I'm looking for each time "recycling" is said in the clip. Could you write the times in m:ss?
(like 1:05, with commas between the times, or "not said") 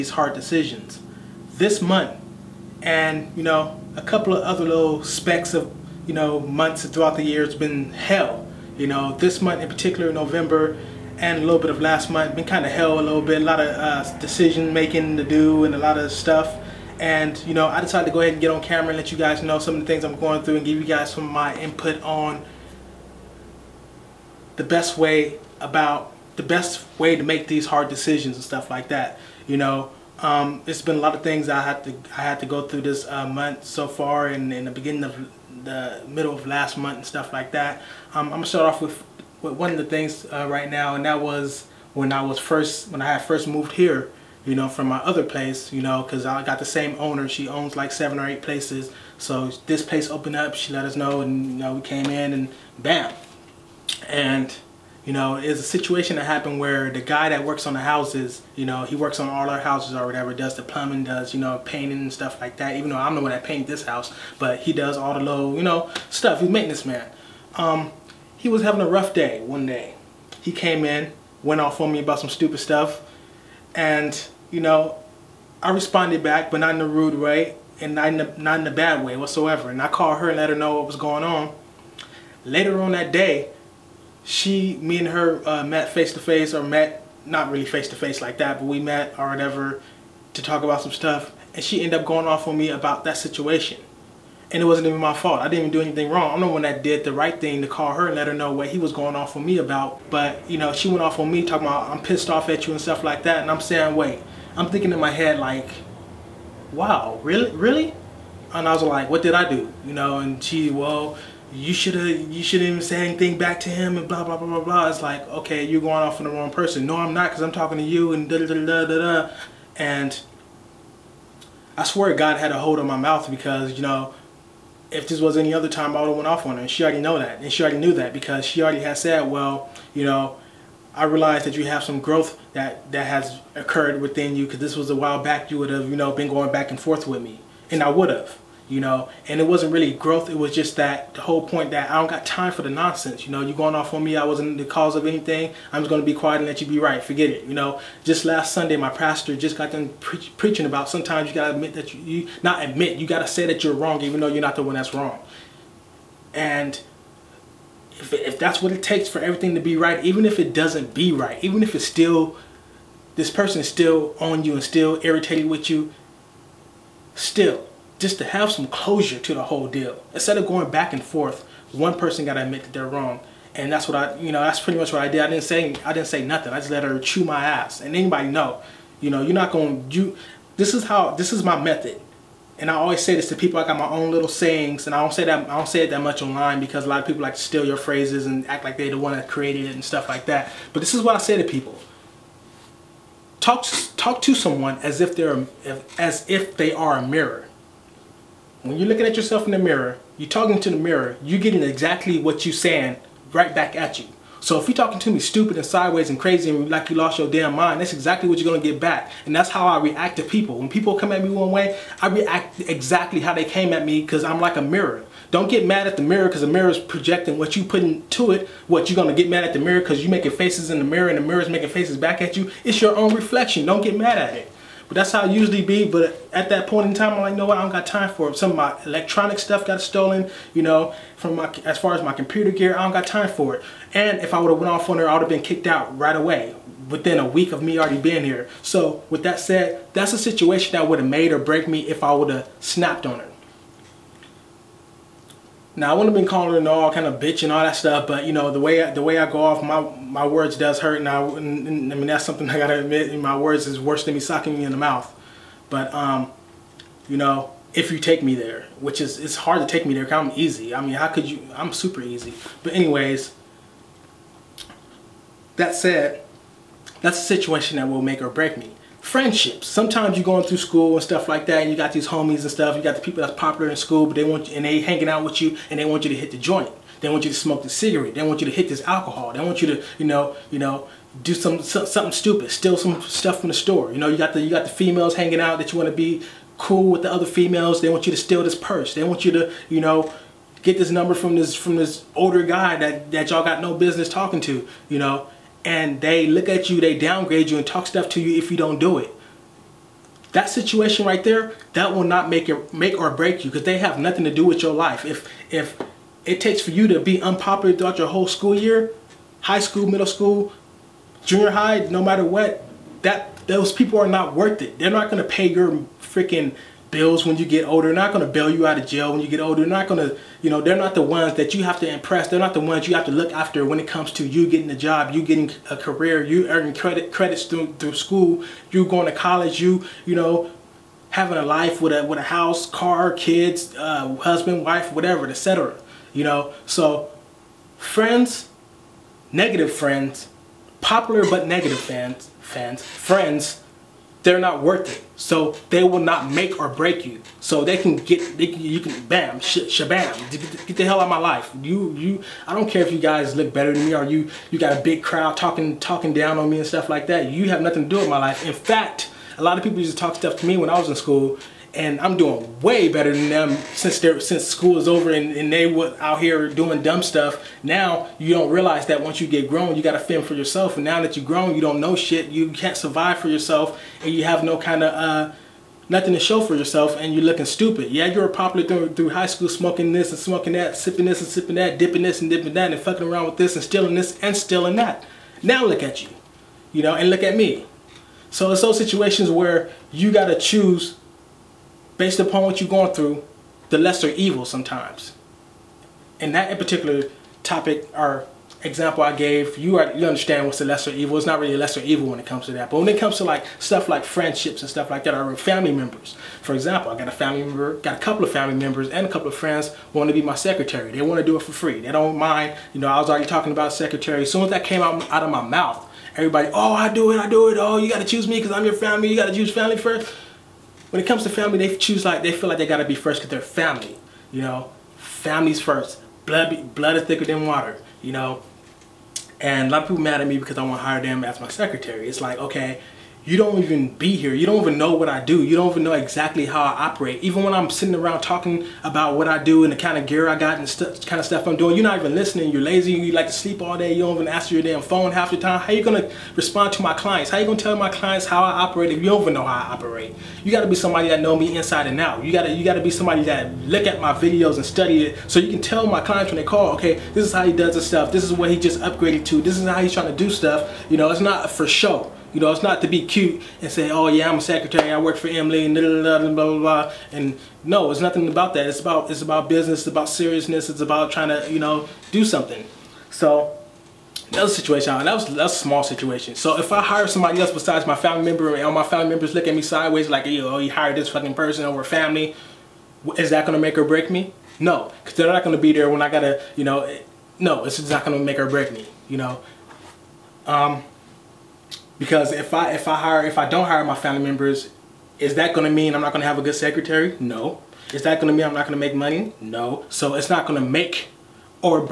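not said.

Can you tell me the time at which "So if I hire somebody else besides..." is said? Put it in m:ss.
7:56.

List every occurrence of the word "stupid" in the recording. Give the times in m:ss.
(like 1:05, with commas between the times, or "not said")
1:12, 3:25, 4:42, 6:17.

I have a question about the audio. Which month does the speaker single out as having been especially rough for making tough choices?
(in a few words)
November.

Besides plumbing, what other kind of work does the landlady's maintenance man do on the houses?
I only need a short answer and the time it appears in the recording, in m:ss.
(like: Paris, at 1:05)
painting, at 1:01.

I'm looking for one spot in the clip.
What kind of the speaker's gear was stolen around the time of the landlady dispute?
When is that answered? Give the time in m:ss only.
3:52.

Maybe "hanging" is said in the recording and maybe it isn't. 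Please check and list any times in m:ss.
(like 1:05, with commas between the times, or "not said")
4:34, 4:45.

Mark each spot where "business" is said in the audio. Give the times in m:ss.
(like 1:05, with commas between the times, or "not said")
4:53, 7:49.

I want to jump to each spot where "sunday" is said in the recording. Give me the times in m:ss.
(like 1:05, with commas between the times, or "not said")
2:28.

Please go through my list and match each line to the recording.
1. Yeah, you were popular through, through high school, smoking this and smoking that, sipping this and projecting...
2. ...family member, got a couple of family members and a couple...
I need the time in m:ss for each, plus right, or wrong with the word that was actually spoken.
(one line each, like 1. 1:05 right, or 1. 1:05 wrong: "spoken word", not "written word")
1. 6:17 wrong: "sipping", not "projecting"
2. 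6:47 right.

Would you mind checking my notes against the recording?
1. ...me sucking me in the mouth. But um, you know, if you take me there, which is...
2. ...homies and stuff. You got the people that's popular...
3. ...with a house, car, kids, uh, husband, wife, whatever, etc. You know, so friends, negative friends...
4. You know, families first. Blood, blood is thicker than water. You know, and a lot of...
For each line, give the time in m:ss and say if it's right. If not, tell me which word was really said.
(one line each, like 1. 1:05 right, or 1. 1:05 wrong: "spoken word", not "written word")
1. 4:14 right
2. 4:32 right
3. 5:32 right
4. 7:04 right.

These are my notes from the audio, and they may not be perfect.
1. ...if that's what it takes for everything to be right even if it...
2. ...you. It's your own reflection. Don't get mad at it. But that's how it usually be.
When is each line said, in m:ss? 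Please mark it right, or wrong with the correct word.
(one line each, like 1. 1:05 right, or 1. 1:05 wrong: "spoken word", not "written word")
1. 2:38 right
2. 3:42 right.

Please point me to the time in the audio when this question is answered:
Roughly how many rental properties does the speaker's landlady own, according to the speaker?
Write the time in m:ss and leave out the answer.
0:47.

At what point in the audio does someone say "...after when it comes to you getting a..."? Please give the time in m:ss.
5:23.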